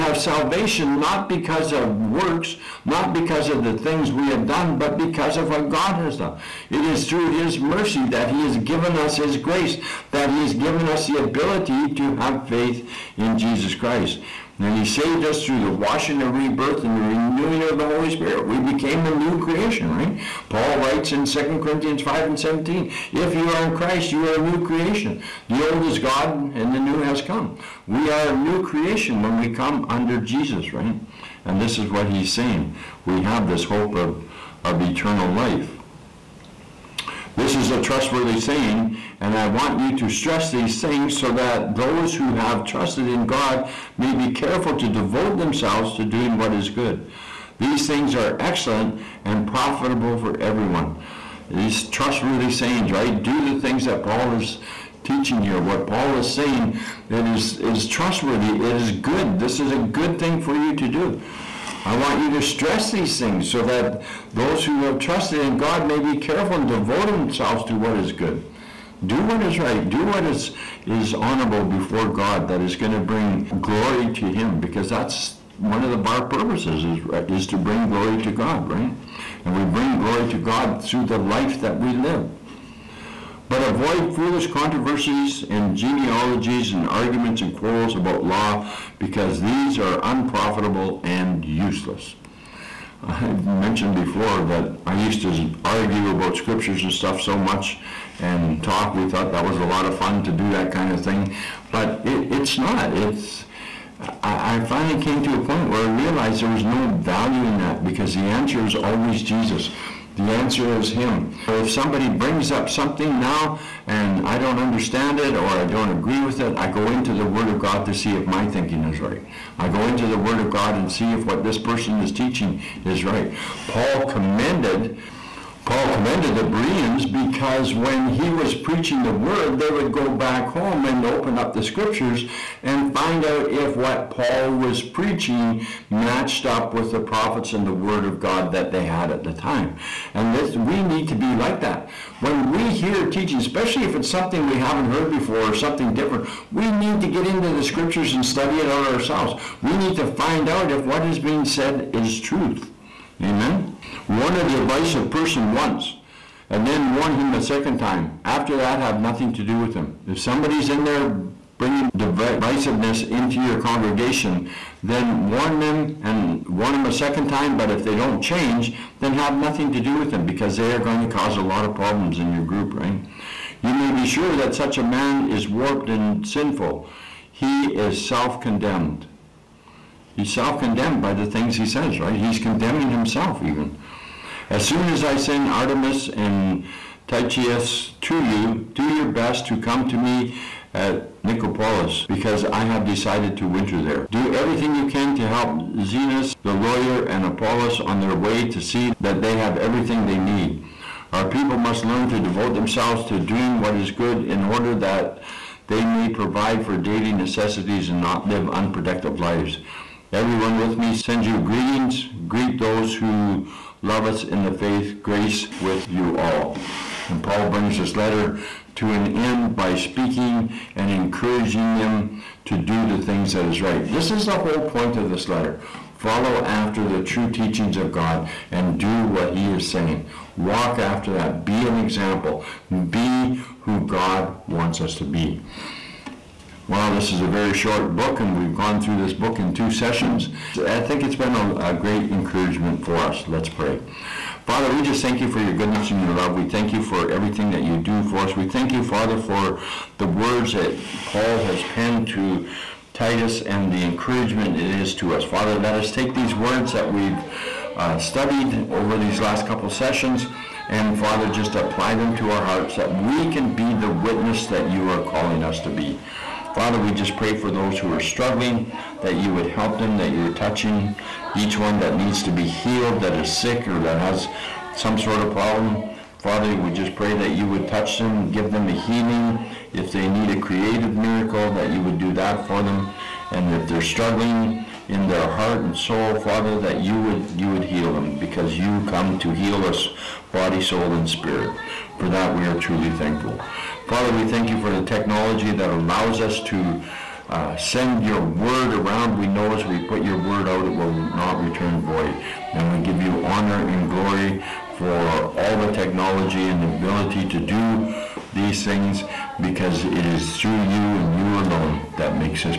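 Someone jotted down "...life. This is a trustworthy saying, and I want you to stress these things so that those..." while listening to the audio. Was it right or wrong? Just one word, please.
right.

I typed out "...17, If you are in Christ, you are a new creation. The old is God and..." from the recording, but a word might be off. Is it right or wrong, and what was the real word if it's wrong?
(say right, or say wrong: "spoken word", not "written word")
right.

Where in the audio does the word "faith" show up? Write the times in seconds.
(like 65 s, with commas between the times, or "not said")
12 s, 214 s.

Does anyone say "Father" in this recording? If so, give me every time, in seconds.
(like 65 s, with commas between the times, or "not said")
244 s, 248 s, 255 s, 260 s, 266 s, 276 s, 286 s, 293 s.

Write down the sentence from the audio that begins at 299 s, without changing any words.
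We know as we put your word out, it will not return void.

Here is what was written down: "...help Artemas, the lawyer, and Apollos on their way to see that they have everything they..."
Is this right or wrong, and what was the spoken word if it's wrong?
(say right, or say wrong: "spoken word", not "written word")
wrong: "Zenas", not "Artemas".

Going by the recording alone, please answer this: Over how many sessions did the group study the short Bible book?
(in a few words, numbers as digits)
2.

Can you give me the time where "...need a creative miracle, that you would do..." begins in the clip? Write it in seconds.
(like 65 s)
280 s.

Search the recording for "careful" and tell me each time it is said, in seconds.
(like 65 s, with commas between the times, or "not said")
44 s, 66 s.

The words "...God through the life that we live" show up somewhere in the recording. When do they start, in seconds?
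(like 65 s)
80 s.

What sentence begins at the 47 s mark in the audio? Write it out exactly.
These things are excellent and profitable for everyone.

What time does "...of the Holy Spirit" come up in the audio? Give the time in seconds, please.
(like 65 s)
17 s.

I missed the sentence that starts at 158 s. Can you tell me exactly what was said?
After that, have nothing to do with him.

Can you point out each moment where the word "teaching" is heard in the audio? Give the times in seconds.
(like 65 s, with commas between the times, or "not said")
55 s, 122 s, 143 s, 227 s.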